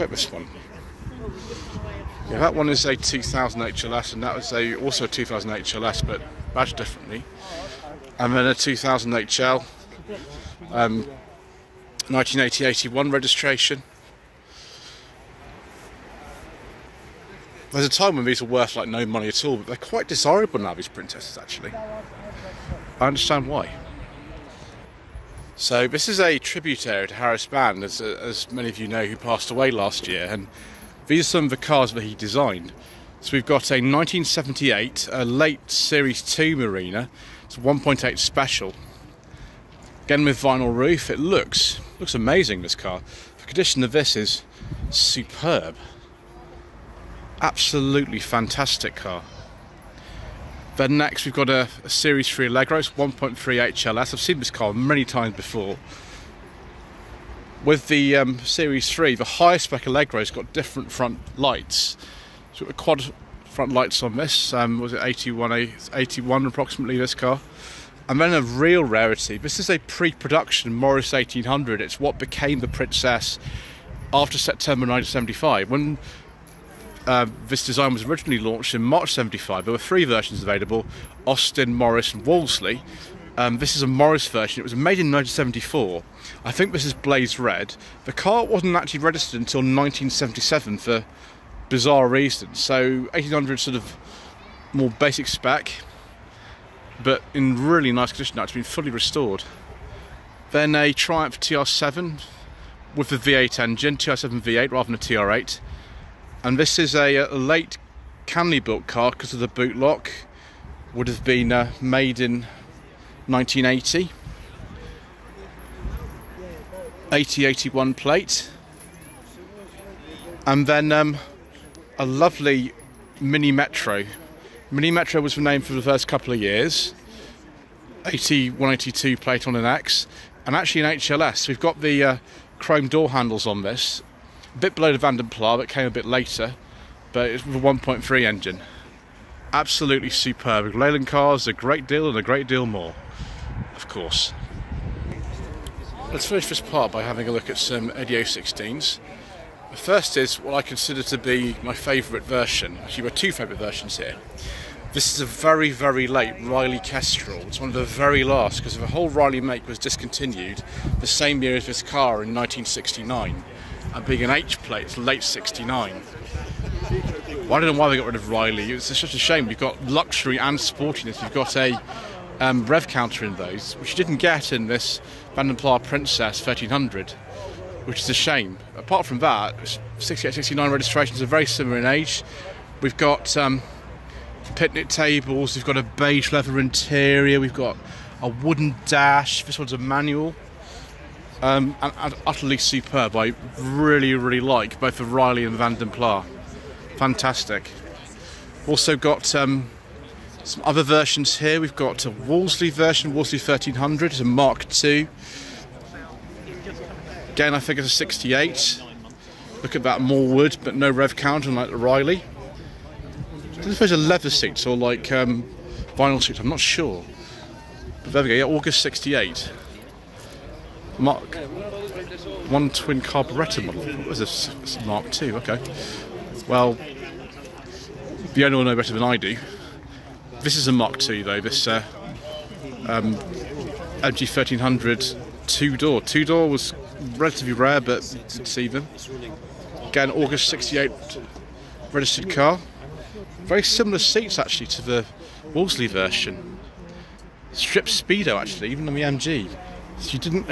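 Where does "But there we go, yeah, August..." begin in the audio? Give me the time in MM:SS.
03:38.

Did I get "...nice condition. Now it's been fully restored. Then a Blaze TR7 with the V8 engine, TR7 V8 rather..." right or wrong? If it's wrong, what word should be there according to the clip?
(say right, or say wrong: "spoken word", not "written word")
wrong: "Triumph", not "Blaze".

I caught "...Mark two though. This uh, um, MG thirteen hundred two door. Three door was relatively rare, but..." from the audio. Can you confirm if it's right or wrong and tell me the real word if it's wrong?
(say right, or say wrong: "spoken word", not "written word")
wrong: "Two", not "Three".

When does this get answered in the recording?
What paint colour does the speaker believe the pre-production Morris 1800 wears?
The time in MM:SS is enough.
01:26.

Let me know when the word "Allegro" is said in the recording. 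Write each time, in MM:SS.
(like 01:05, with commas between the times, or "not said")
00:52, 00:59.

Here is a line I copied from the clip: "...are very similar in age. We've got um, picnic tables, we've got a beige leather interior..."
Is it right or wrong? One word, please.
right.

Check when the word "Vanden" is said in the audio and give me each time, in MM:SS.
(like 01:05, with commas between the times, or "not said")
02:14, 02:55, 03:15.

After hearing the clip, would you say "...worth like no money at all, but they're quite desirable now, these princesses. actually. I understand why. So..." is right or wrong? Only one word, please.
right.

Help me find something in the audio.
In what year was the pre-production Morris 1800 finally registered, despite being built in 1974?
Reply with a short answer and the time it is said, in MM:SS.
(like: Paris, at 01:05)
1977, at 01:29.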